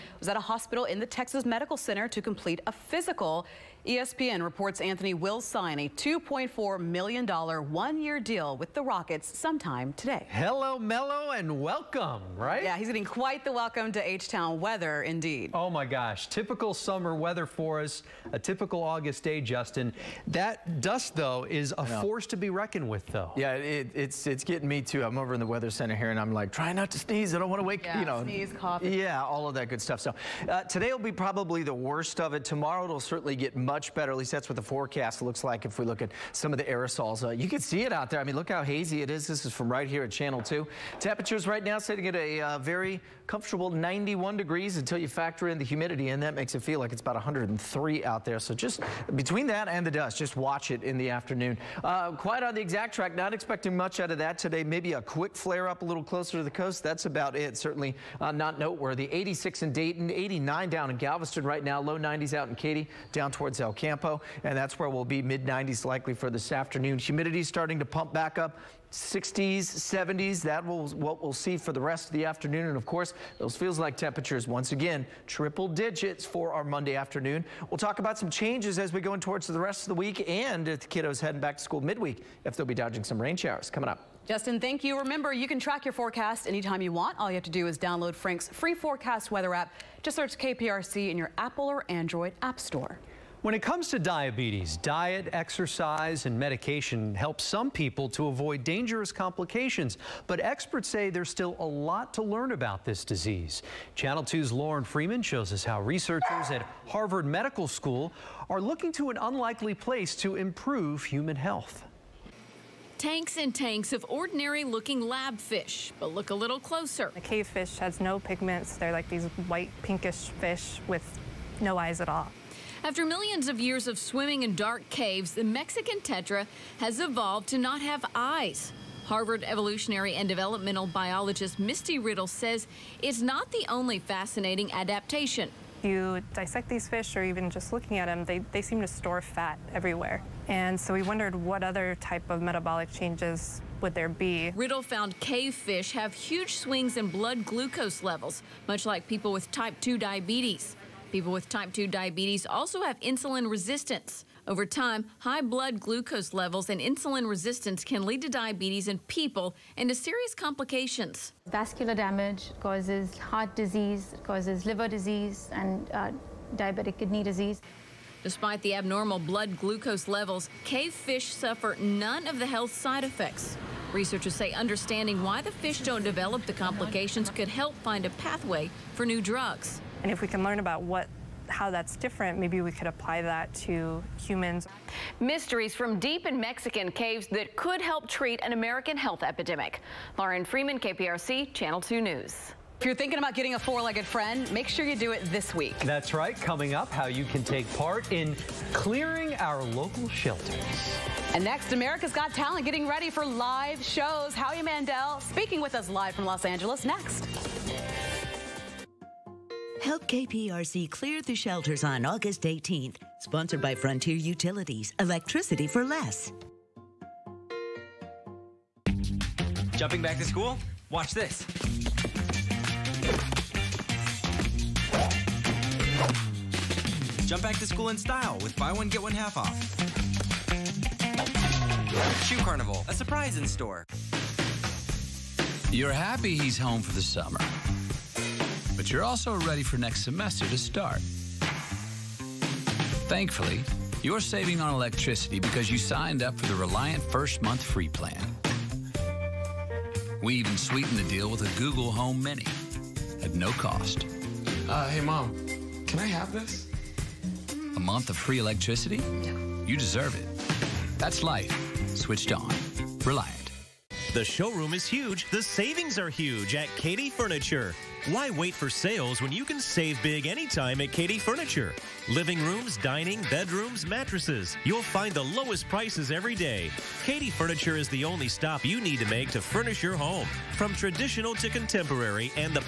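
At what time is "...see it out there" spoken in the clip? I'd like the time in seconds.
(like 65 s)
37 s.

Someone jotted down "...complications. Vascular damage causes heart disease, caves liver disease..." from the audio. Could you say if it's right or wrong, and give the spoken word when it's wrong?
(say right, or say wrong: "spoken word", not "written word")
wrong: "causes", not "caves".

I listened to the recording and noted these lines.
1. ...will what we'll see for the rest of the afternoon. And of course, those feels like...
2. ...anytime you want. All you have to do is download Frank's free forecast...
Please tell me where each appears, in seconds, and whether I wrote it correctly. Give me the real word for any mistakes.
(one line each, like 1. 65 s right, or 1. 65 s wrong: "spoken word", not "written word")
1. 70 s right
2. 86 s right.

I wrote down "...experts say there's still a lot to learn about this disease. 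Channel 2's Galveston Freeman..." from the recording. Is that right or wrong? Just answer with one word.
wrong.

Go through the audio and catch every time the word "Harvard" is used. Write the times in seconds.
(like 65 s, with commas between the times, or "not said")
106 s, 129 s.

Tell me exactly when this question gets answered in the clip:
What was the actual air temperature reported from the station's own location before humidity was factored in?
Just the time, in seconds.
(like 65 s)
43 s.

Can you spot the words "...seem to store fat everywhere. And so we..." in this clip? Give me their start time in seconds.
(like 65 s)
138 s.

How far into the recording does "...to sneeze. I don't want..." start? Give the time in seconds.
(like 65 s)
26 s.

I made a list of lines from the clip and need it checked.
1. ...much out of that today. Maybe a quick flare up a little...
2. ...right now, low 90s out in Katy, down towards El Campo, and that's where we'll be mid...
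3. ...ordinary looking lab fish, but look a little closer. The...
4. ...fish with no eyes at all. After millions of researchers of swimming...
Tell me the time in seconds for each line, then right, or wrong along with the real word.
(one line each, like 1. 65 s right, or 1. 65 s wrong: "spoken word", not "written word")
1. 53 s right
2. 61 s right
3. 114 s right
4. 120 s wrong: "years", not "researchers".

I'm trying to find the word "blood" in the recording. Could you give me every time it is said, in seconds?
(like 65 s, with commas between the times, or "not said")
147 s, 155 s, 169 s.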